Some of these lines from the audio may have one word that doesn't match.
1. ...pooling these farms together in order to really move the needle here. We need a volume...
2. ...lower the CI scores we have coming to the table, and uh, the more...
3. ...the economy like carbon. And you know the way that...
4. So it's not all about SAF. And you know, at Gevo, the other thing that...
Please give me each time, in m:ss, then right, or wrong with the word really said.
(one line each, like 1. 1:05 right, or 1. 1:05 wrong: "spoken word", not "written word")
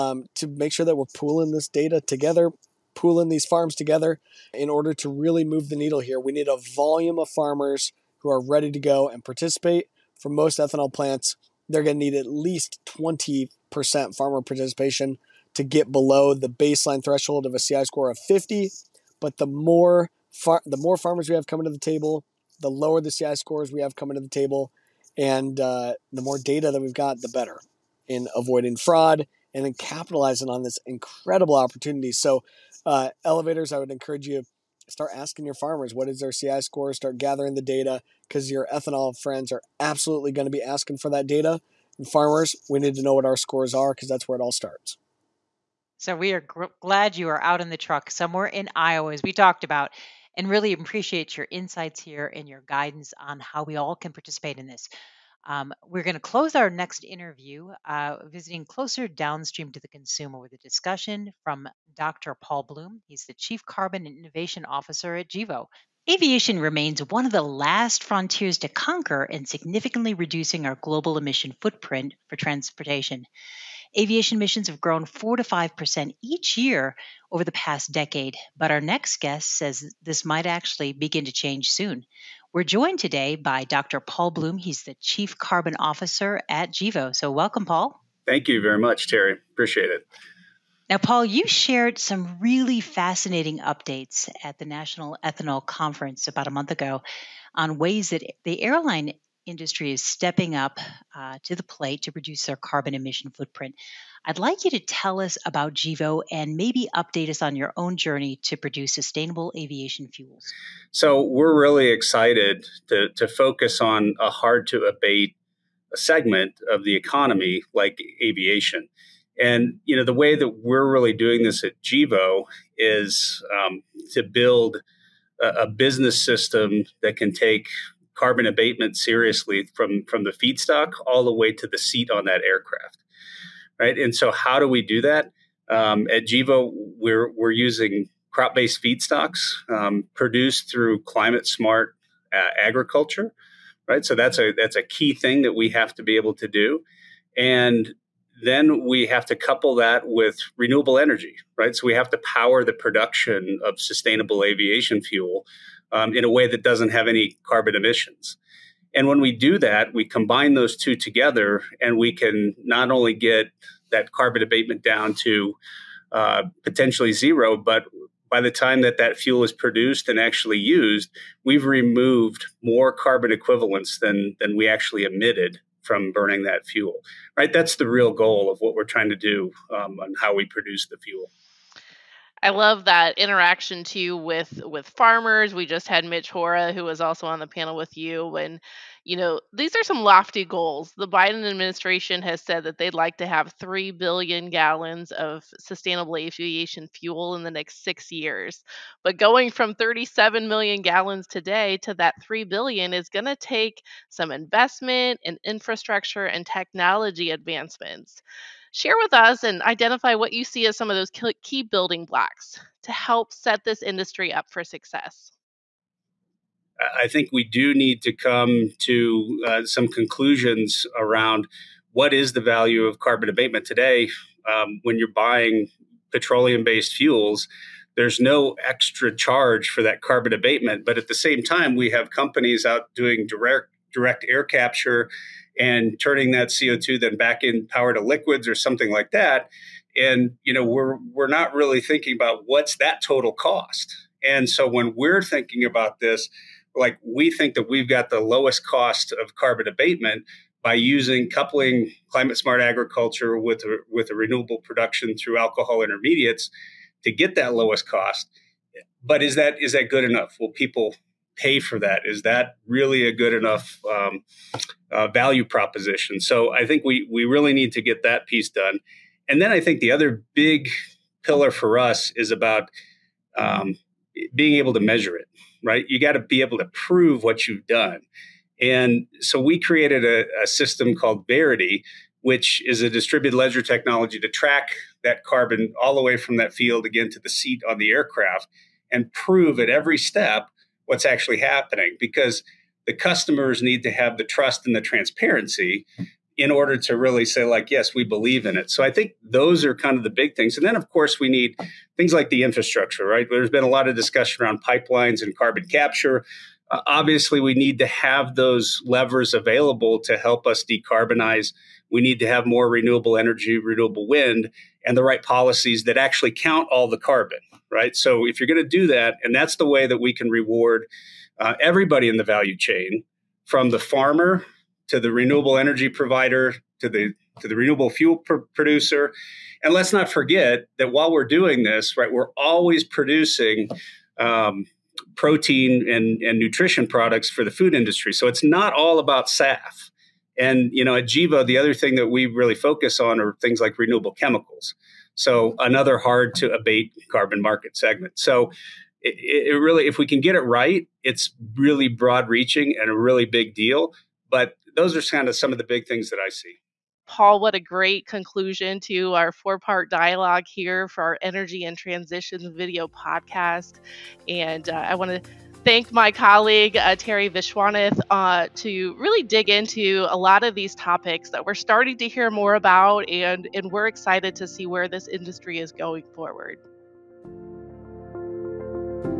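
1. 0:02 right
2. 0:22 right
3. 1:56 wrong: "aviation", not "carbon"
4. 5:38 right.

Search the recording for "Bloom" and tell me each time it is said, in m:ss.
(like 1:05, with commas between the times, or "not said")
1:02, 1:24.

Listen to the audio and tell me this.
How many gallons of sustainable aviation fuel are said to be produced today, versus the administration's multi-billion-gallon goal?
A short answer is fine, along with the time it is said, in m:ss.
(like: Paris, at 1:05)
37 million gallons, at 3:19.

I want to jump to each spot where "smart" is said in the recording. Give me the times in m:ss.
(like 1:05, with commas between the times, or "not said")
2:21, 4:12.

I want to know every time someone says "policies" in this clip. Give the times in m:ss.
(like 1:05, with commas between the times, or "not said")
5:15.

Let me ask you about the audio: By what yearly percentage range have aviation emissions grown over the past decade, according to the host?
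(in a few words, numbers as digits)
4 to 5%.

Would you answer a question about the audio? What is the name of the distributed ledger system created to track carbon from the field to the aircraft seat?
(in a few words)
Verity.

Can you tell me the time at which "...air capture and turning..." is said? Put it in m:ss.
3:54.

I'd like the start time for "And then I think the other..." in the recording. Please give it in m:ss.
4:29.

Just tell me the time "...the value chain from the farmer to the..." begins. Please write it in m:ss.
5:22.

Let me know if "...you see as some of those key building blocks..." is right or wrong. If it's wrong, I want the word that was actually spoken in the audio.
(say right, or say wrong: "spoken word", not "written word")
right.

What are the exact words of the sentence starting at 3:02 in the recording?
I love that interaction too with with farmers.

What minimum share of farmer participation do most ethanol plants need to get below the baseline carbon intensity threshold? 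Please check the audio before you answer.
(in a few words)
20%.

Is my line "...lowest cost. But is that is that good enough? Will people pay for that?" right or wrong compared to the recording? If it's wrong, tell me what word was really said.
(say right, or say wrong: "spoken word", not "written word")
right.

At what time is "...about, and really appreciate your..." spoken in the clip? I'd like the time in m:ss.
0:49.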